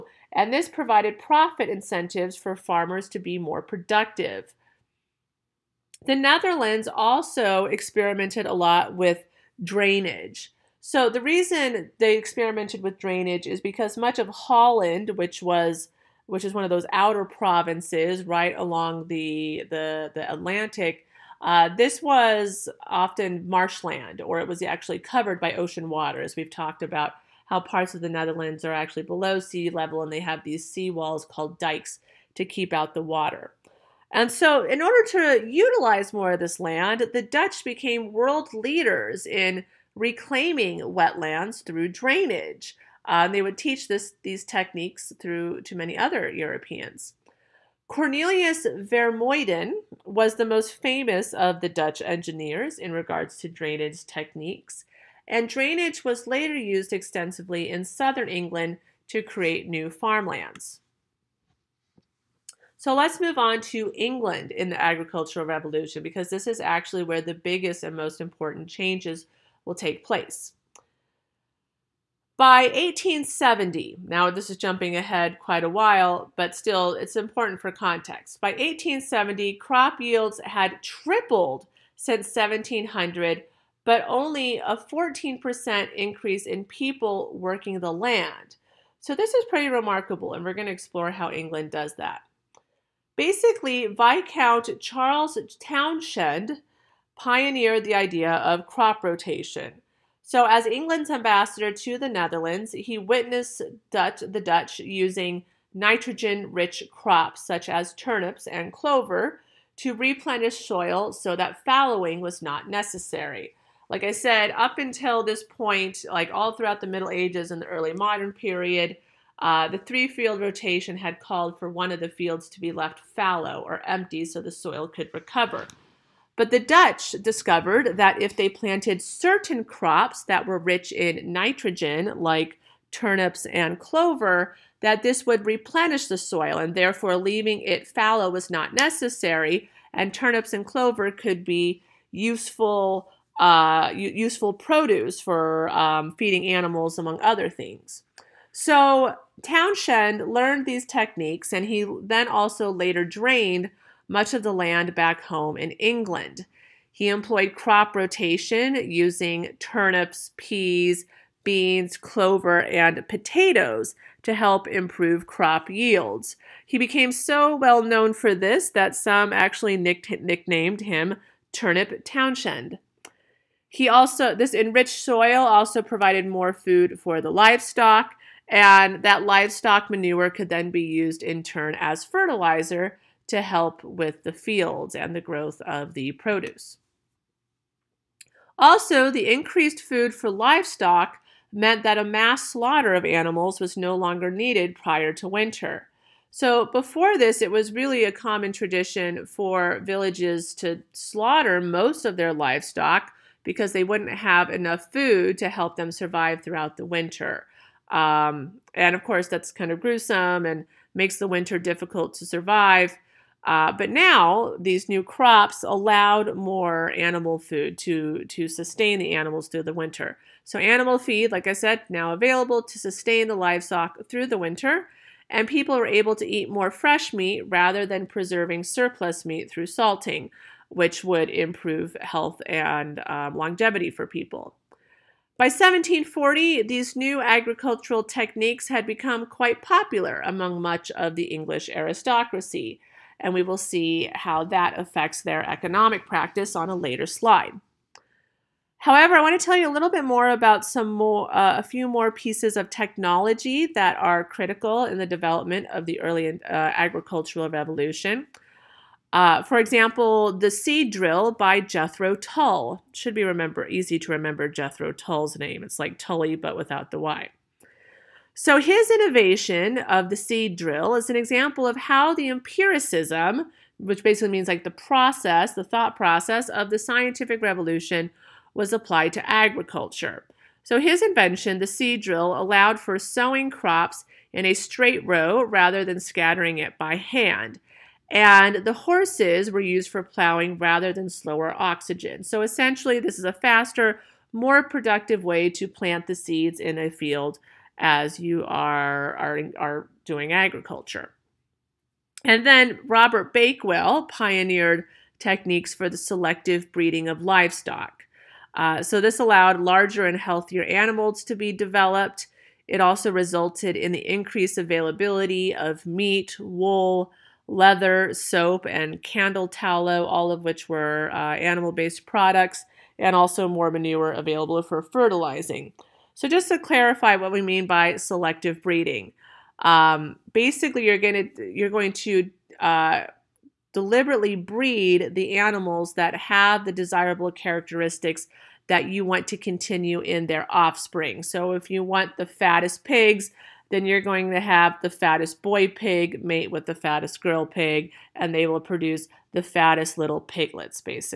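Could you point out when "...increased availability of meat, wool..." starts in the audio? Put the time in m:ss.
5:14.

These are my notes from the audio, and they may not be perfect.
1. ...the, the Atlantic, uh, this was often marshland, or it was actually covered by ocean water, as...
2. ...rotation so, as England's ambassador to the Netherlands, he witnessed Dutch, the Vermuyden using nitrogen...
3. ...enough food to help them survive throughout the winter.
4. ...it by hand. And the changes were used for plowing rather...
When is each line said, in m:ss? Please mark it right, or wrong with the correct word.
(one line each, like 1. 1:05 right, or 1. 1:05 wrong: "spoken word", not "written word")
1. 0:19 right
2. 1:39 wrong: "Dutch", not "Vermuyden"
3. 3:24 right
4. 4:46 wrong: "horses", not "changes".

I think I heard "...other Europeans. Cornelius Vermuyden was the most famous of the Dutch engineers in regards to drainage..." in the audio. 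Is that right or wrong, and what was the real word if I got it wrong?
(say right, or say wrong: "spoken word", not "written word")
right.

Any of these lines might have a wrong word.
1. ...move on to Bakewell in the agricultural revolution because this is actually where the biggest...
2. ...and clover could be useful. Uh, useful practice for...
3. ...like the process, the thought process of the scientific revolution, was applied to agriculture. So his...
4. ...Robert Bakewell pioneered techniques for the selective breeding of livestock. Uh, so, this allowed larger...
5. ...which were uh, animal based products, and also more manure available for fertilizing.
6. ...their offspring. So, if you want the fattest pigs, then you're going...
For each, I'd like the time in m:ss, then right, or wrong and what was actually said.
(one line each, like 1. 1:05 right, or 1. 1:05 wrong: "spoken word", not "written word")
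1. 1:03 wrong: "England", not "Bakewell"
2. 2:20 wrong: "produce", not "practice"
3. 4:34 right
4. 5:02 right
5. 5:20 right
6. 5:40 right.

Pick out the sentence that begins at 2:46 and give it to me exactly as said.
He became so well known for this that some actually nicknamed him Turnip Townshend.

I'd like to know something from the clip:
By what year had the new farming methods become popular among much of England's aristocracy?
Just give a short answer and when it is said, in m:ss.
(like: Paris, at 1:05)
1740, at 3:55.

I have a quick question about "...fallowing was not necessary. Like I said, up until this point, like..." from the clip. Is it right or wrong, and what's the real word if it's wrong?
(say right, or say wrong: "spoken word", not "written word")
right.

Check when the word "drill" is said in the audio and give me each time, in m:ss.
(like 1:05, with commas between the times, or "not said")
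4:20, 4:30, 4:42.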